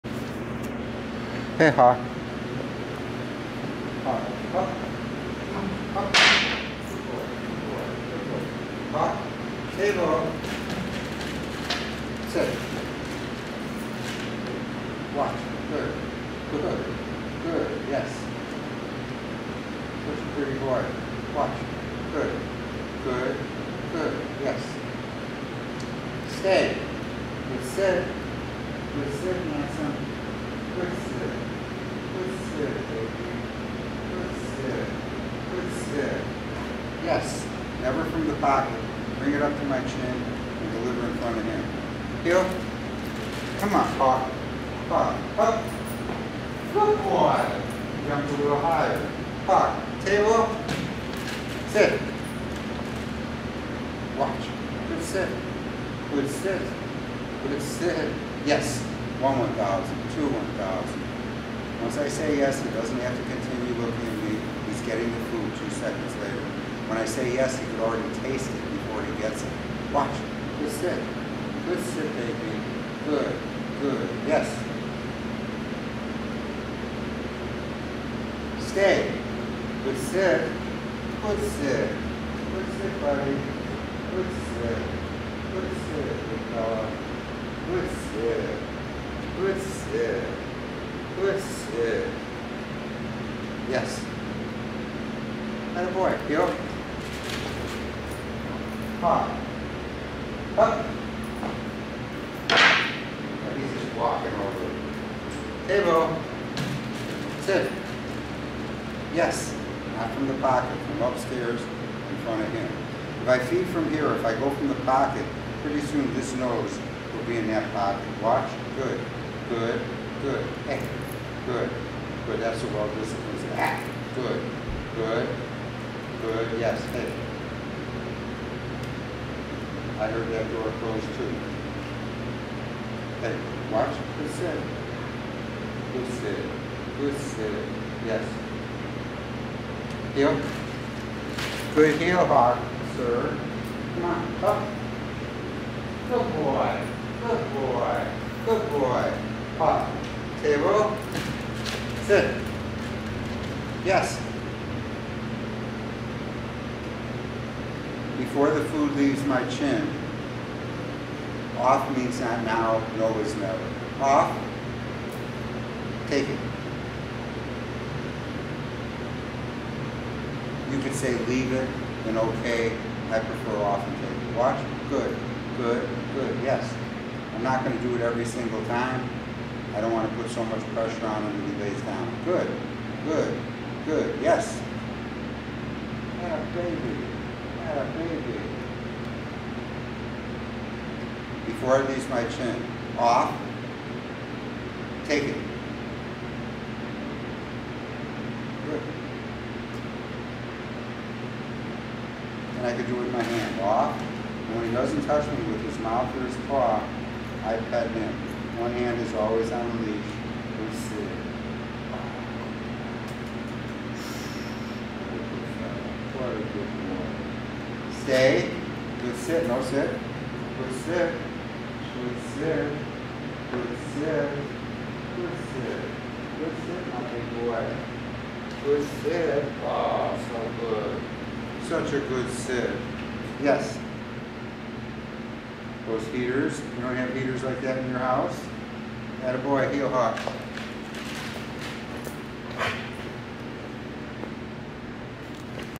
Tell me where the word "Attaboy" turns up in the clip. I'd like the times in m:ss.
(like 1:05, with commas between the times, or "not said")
3:59.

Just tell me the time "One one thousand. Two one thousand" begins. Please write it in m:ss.
0:59.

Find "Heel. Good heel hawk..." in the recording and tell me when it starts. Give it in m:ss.
2:20.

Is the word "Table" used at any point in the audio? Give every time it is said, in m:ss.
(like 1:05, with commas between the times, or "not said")
0:09, 0:50, 2:30.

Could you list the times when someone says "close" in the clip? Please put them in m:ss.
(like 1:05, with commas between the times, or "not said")
2:10.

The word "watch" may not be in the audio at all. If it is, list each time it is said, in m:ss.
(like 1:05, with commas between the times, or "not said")
0:15, 0:54, 1:09, 1:58, 2:13, 2:54.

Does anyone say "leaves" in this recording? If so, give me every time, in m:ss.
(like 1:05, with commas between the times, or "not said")
2:38, 2:51.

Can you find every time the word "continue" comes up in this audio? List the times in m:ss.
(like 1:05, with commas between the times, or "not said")
1:03.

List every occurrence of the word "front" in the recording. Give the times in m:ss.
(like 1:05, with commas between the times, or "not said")
0:41, 1:52.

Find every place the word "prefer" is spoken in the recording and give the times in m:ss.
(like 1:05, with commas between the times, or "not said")
2:53.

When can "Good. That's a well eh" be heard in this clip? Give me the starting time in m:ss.
2:02.